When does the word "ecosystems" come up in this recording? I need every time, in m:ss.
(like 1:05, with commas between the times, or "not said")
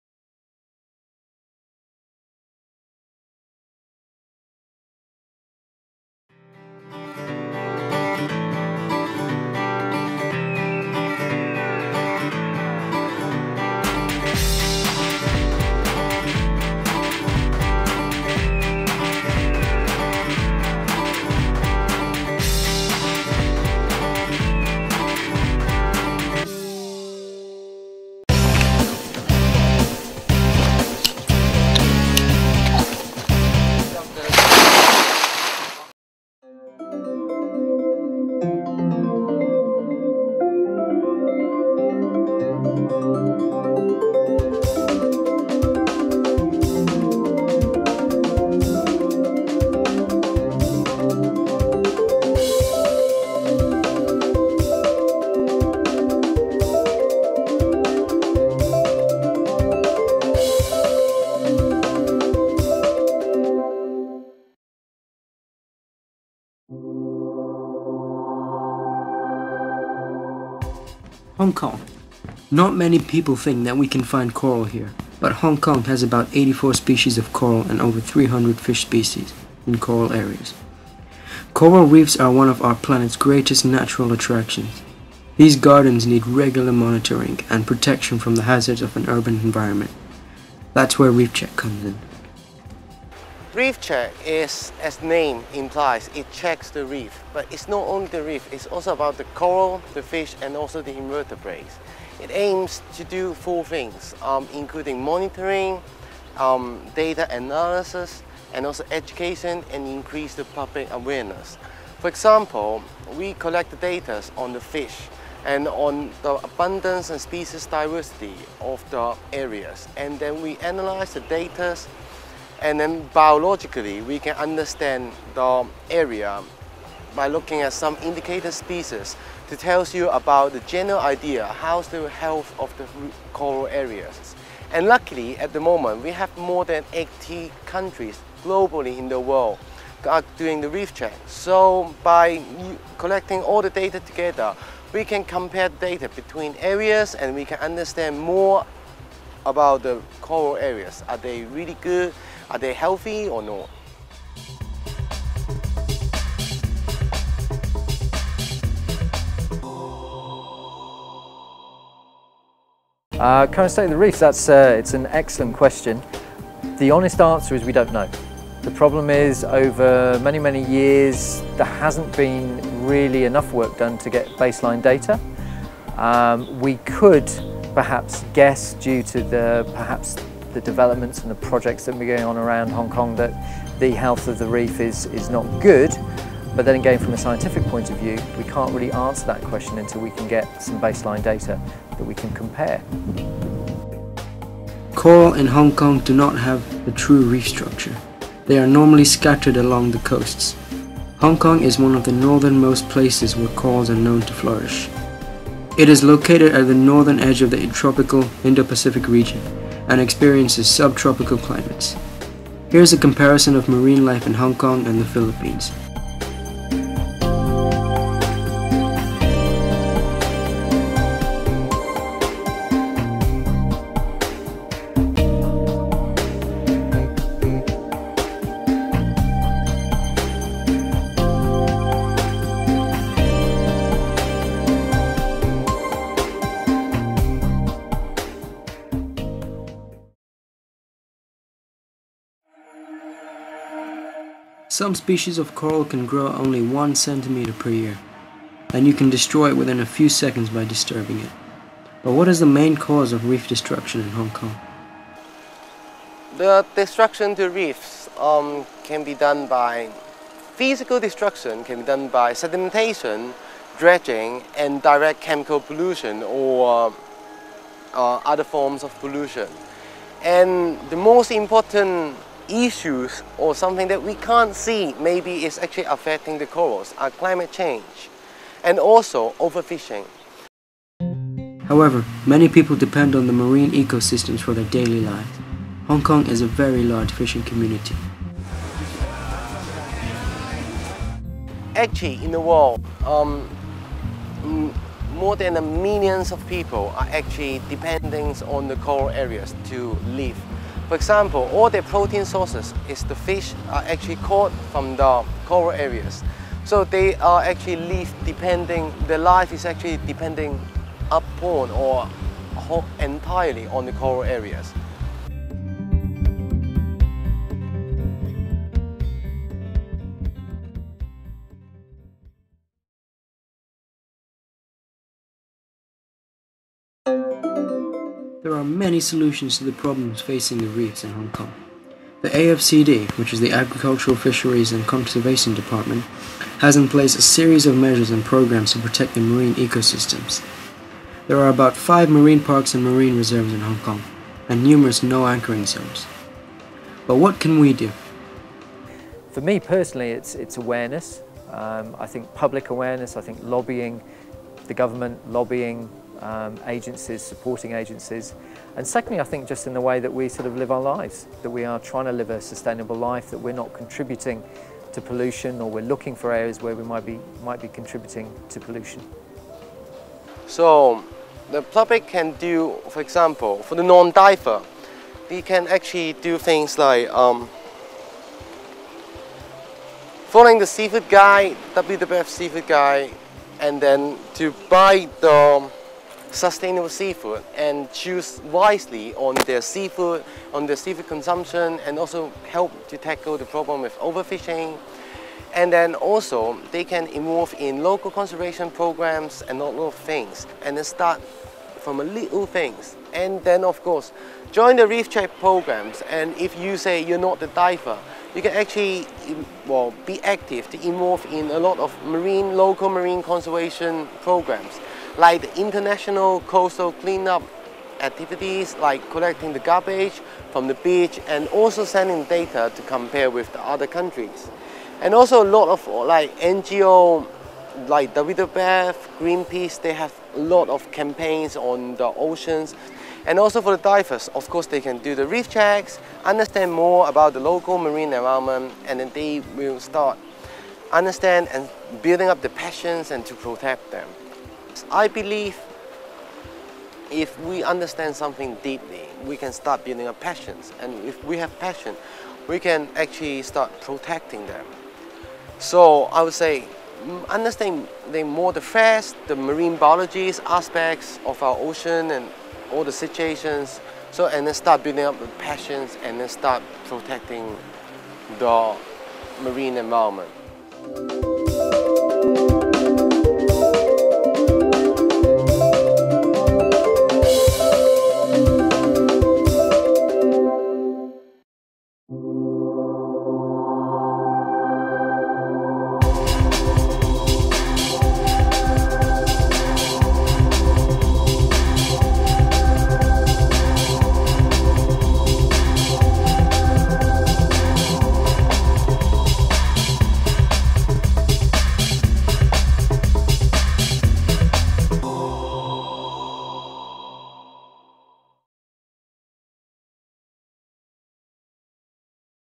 4:43, 5:39.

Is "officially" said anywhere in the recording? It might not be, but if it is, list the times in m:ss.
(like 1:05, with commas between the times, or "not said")
not said.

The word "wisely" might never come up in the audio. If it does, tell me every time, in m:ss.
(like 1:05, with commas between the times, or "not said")
6:28.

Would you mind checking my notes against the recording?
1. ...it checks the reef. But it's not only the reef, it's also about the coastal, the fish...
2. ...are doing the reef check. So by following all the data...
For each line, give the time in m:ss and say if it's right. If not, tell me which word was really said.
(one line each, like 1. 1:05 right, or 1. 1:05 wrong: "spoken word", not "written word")
1. 1:36 wrong: "coral", not "coastal"
2. 2:20 wrong: "collecting", not "following".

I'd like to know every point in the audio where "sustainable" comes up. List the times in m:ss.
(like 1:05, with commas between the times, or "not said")
6:02, 6:26.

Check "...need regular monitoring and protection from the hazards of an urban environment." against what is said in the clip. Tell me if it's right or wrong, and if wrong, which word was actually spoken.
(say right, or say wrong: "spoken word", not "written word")
right.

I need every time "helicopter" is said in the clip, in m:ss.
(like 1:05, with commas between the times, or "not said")
not said.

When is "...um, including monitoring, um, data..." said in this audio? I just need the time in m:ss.
1:44.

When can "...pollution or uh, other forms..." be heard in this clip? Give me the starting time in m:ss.
4:25.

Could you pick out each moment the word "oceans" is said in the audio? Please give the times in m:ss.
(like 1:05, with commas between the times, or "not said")
7:12, 7:41.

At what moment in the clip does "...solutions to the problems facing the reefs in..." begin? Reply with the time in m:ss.
5:28.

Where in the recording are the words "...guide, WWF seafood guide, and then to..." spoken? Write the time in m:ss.
6:21.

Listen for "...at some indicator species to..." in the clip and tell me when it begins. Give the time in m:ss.
2:07.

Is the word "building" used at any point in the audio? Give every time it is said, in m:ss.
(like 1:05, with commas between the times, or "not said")
7:22, 7:29, 7:44.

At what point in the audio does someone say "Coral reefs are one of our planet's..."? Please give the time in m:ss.
1:21.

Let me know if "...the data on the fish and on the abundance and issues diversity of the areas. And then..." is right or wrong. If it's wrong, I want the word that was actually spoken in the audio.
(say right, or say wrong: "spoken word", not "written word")
wrong: "species", not "issues".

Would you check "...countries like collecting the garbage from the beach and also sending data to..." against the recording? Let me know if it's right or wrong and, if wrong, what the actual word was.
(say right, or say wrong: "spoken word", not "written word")
wrong: "activities", not "countries".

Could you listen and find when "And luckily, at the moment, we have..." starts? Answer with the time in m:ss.
2:14.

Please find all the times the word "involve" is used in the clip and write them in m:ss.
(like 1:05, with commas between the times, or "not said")
6:37, 6:50.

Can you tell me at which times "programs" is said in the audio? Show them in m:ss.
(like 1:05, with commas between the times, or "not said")
5:38, 6:38, 6:45, 6:54.